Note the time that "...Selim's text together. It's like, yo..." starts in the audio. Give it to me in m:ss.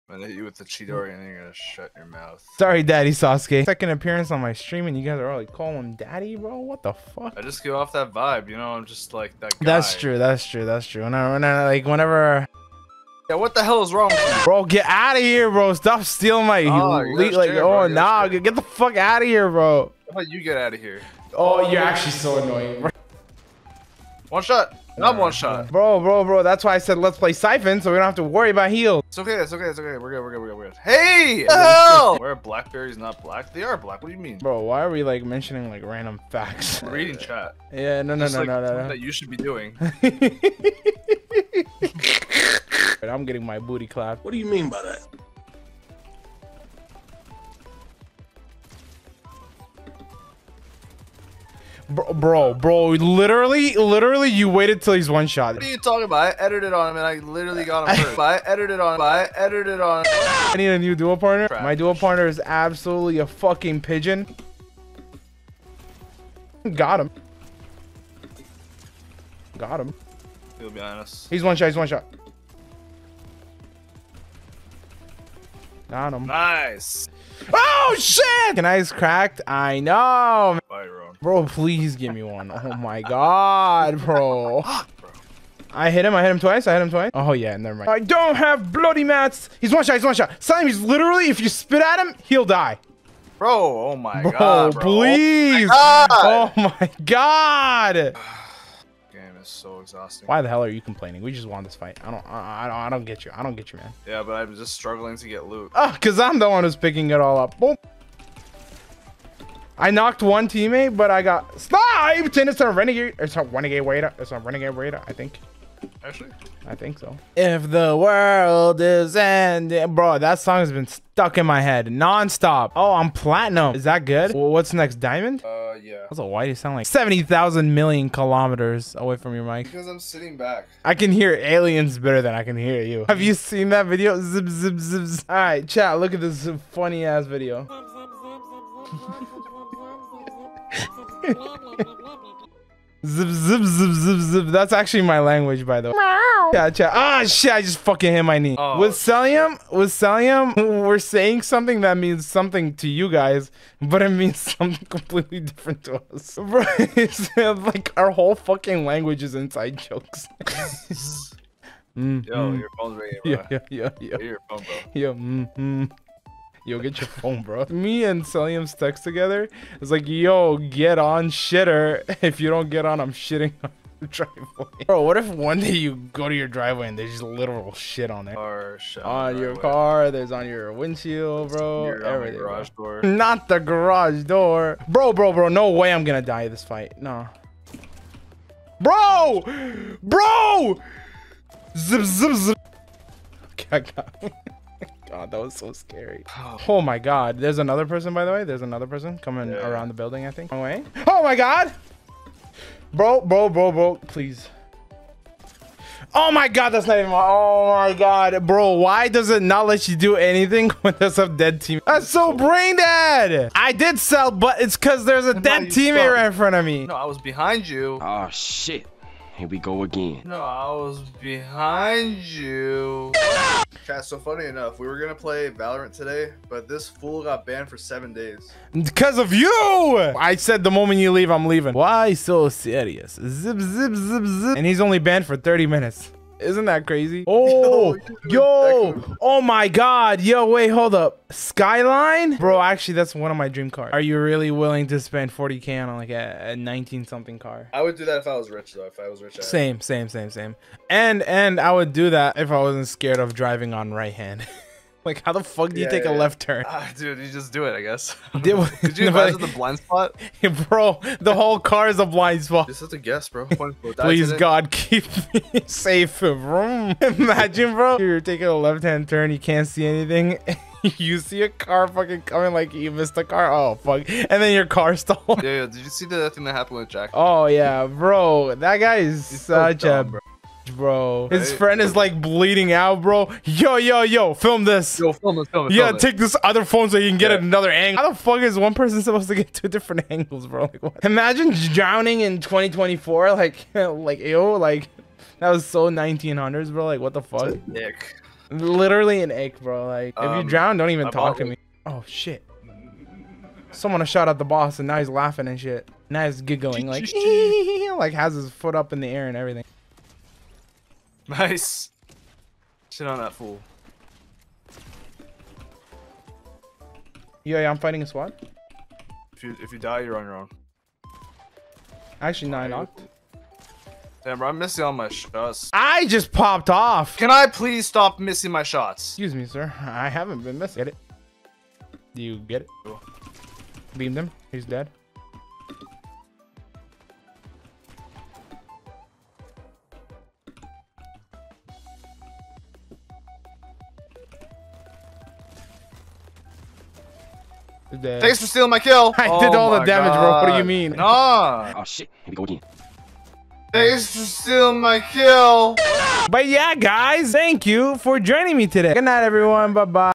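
2:48.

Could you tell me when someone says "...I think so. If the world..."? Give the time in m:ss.
1:56.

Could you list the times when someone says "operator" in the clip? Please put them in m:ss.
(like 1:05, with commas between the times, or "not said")
not said.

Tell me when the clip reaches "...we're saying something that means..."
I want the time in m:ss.
2:30.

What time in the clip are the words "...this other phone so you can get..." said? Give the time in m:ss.
4:46.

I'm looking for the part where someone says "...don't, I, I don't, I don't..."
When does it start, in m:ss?
1:42.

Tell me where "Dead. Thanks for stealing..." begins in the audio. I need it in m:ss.
5:47.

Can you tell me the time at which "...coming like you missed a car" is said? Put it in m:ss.
4:32.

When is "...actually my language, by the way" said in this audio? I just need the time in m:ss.
2:24.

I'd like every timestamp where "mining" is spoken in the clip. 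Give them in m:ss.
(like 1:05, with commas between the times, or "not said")
not said.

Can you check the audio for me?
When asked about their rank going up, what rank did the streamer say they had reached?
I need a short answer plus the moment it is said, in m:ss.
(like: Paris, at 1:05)
Platinum, at 2:03.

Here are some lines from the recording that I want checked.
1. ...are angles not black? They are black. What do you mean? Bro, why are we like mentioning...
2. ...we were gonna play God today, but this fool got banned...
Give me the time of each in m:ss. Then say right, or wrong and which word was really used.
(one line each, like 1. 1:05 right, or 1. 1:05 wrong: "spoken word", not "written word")
1. 0:32 wrong: "blackberries", not "angles"
2. 3:44 wrong: "Valorant", not "God".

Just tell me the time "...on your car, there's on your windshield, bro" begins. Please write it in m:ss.
2:59.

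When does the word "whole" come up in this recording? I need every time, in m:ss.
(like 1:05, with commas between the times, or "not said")
2:38, 4:21.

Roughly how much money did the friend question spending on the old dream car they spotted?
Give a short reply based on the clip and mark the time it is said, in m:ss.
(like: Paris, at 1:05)
40k, at 4:05.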